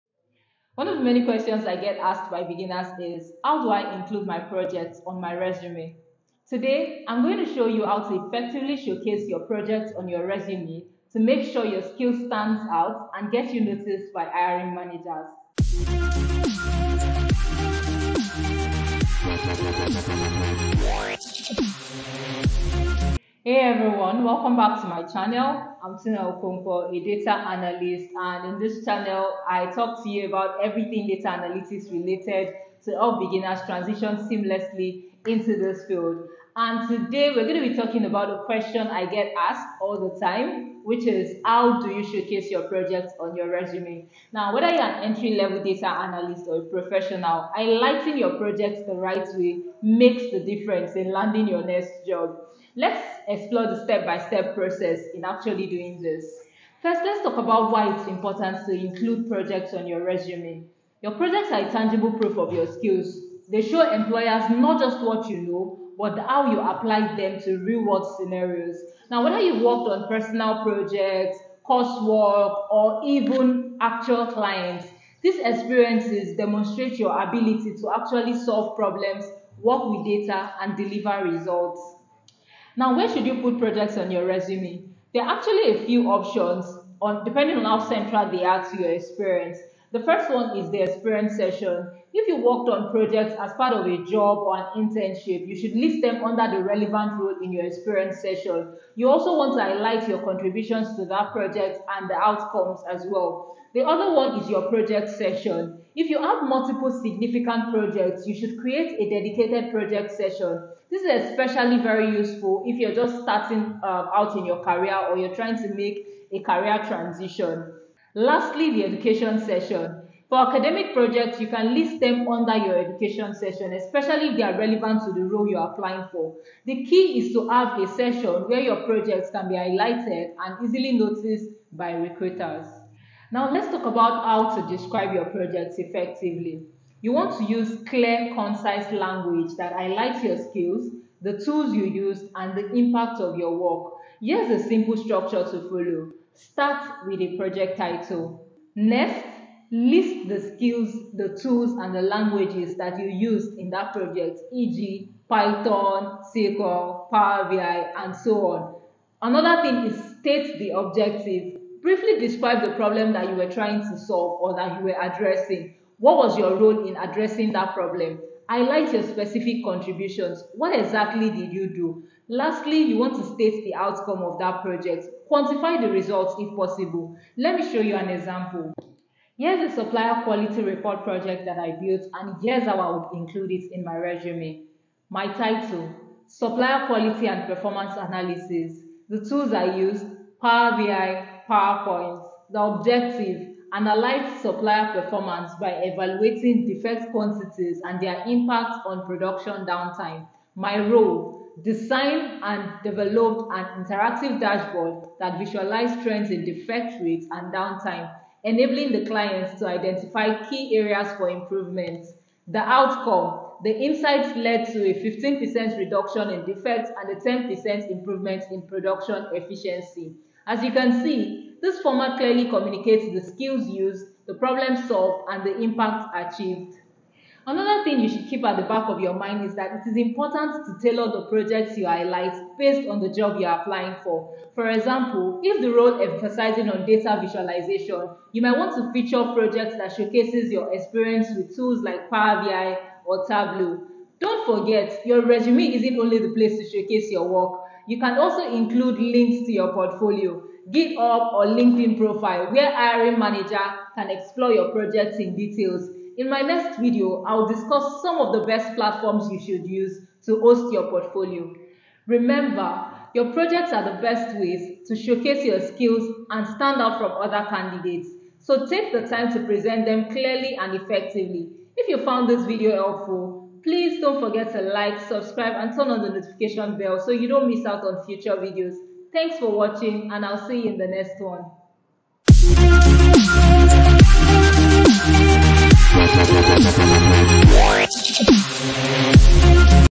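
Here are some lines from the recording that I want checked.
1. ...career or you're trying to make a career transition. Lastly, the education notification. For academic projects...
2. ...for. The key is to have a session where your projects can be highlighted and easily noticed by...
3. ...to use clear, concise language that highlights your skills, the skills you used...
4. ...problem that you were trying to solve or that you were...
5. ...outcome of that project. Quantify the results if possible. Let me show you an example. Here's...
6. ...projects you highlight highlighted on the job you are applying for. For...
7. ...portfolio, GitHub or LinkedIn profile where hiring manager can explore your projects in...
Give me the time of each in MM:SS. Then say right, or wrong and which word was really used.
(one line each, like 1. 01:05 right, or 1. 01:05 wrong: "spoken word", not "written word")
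1. 01:54 wrong: "session", not "notification"
2. 02:06 right
3. 02:17 wrong: "tools", not "skills"
4. 02:42 right
5. 02:53 right
6. 03:51 wrong: "based", not "highlighted"
7. 04:09 right.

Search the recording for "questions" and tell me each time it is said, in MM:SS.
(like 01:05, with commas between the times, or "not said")
00:01, 00:38.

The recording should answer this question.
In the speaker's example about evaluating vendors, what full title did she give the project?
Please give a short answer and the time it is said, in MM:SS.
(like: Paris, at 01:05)
Supplier Quality and Performance Analysis, at 03:06.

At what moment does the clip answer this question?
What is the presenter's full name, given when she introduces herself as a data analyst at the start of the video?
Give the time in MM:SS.
00:25.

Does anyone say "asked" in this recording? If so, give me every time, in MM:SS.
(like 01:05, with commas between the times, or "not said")
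00:01, 00:39.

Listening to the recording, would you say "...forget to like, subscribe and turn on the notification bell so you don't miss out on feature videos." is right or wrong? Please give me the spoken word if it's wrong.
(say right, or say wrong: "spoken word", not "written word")
wrong: "future", not "feature".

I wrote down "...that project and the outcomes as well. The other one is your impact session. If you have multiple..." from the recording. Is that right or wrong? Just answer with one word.
wrong.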